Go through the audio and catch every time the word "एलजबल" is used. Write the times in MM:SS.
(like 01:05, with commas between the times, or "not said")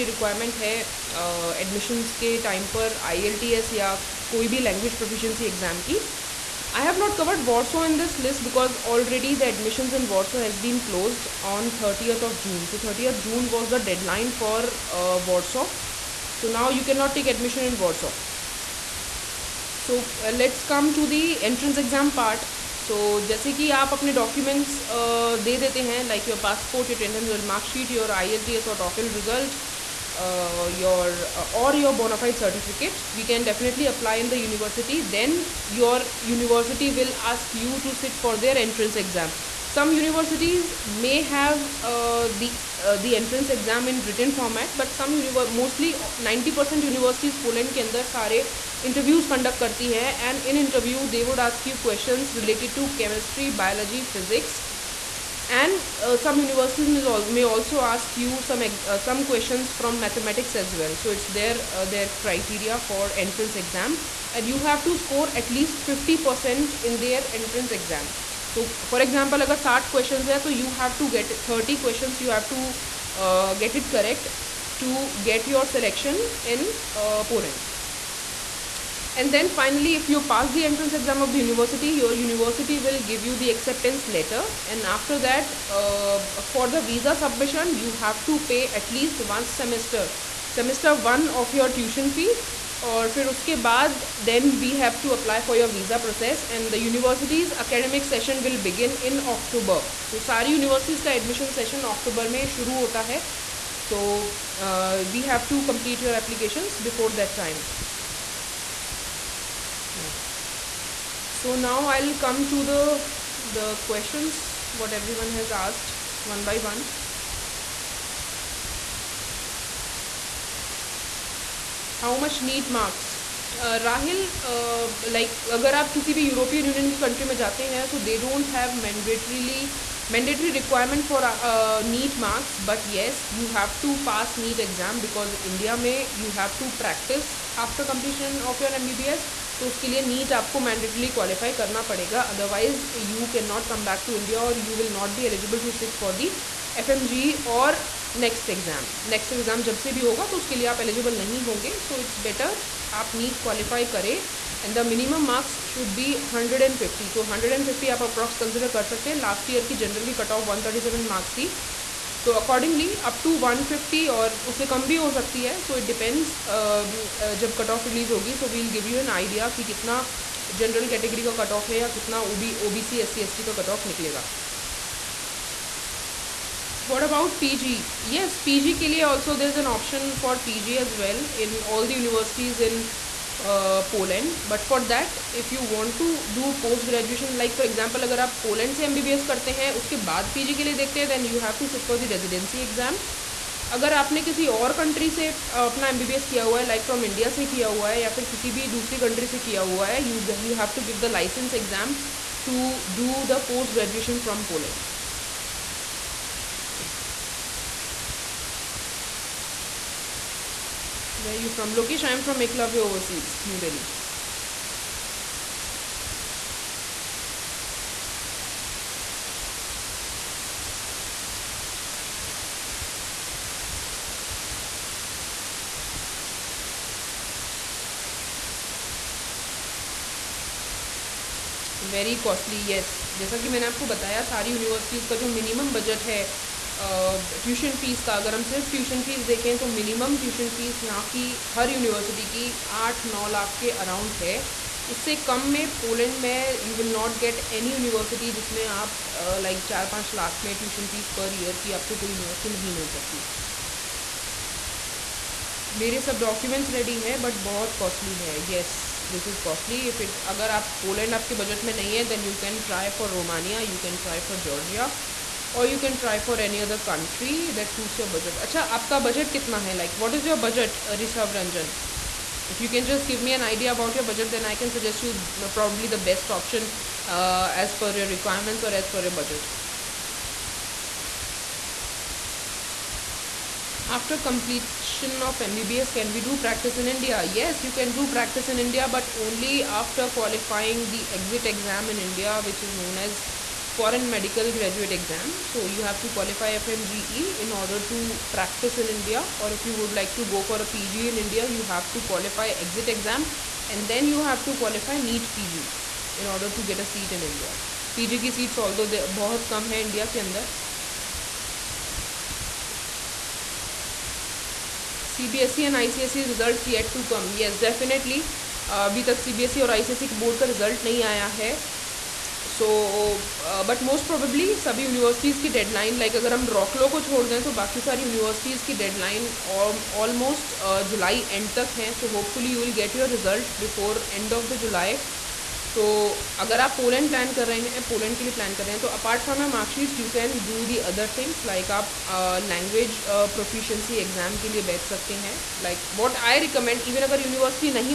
02:25, 02:30.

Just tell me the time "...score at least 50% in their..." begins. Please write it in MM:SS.
01:04.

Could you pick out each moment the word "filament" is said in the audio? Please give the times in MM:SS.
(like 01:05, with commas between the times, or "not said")
not said.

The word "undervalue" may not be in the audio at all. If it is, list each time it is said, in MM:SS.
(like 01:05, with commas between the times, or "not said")
not said.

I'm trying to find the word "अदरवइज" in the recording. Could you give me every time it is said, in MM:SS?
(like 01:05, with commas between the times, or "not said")
02:22.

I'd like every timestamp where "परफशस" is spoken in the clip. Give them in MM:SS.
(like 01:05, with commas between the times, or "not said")
00:04, 05:43.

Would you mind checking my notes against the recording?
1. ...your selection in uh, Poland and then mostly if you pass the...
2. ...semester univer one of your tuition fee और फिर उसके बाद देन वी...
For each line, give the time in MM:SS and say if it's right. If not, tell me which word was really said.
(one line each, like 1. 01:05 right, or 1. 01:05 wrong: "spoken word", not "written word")
1. 01:15 wrong: "finally", not "mostly"
2. 01:29 wrong: "semester", not "univer".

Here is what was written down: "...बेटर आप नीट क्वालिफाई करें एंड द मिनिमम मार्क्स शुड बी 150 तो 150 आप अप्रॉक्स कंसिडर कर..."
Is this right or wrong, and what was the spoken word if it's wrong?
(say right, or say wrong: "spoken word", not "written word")
right.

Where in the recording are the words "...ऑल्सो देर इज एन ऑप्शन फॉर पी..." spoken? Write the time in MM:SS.
02:59.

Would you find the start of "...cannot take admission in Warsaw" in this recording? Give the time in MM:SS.
00:16.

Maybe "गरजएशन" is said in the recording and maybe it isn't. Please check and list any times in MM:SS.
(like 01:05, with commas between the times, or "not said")
03:06, 03:23.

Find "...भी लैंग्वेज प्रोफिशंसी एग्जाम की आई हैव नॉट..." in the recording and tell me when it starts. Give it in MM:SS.
00:04.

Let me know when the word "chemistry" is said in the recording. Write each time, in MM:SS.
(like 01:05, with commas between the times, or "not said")
00:53.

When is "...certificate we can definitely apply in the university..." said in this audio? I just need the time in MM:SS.
00:32.